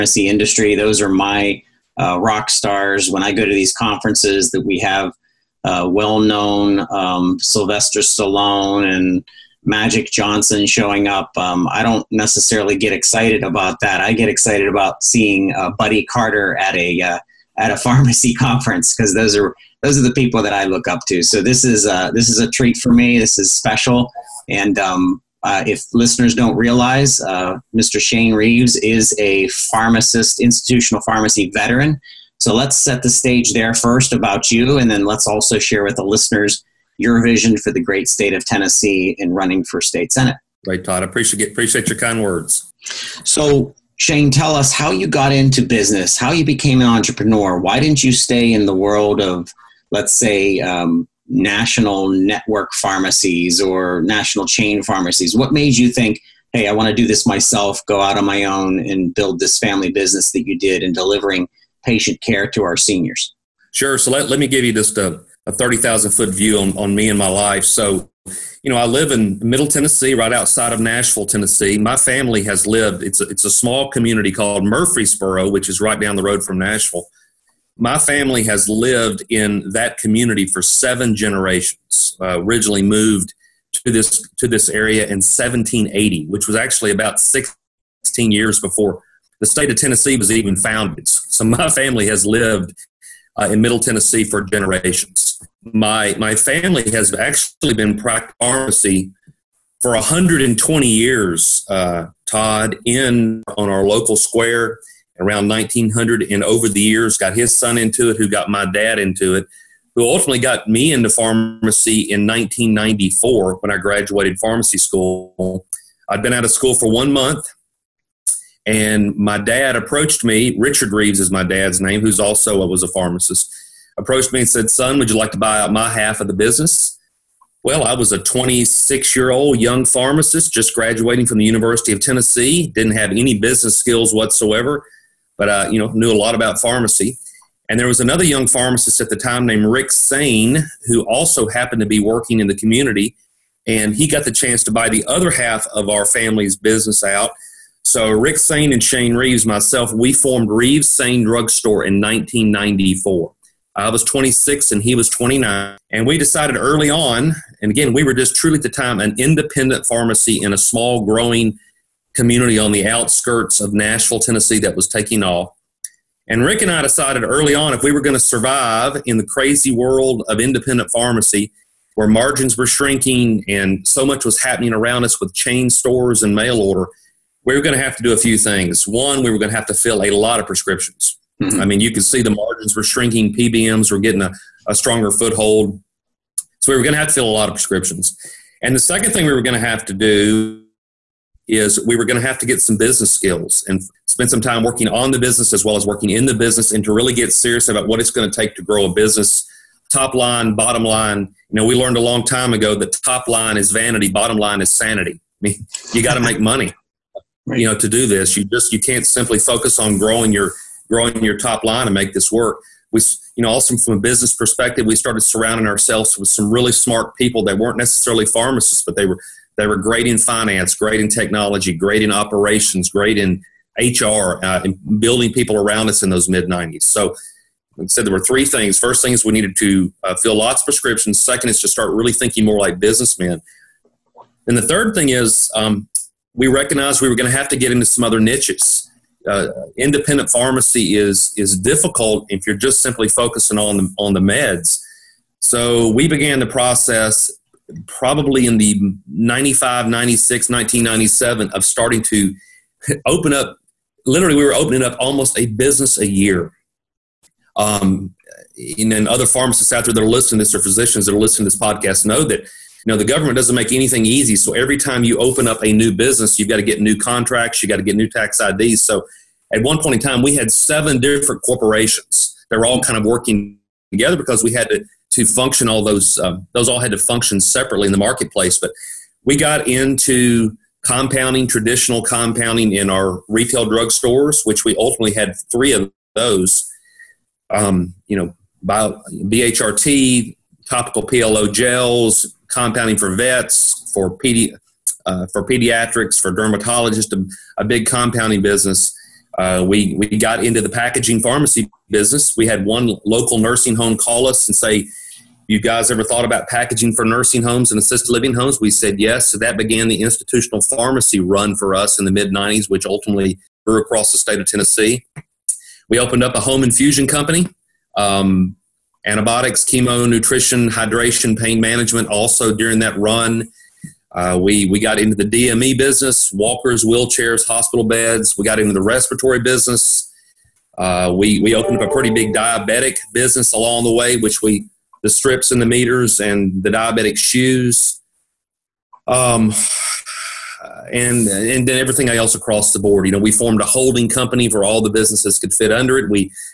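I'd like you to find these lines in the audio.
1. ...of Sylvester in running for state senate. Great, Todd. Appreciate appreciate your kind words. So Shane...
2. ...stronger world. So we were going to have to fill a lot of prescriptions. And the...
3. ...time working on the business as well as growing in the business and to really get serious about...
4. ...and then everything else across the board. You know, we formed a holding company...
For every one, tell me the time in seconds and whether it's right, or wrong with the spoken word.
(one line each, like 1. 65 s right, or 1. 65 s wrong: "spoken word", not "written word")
1. 38 s wrong: "Tennessee", not "Sylvester"
2. 184 s wrong: "foothold", not "world"
3. 194 s wrong: "working", not "growing"
4. 341 s right.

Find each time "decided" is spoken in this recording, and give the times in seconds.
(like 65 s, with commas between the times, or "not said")
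156 s, 166 s.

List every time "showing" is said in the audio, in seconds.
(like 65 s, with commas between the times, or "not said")
10 s.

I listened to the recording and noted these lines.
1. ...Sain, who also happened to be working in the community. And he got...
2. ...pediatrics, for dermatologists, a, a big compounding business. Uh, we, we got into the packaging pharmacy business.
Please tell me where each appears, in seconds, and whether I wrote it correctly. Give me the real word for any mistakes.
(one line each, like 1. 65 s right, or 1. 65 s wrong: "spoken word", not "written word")
1. 139 s right
2. 295 s right.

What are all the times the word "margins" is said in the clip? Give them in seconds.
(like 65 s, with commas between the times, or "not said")
172 s, 182 s.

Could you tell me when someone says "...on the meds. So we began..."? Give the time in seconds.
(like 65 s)
243 s.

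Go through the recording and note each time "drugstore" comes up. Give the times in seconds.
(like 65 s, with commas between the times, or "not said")
151 s, 283 s.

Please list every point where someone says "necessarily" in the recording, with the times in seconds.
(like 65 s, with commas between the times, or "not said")
12 s, 217 s.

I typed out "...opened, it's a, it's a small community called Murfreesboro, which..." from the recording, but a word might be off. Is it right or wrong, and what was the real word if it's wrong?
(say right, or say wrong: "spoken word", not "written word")
wrong: "lived", not "opened".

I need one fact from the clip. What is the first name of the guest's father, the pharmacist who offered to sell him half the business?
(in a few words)
Richard.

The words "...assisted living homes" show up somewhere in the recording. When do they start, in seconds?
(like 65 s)
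307 s.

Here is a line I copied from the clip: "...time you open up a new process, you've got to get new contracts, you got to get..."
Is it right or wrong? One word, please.
wrong.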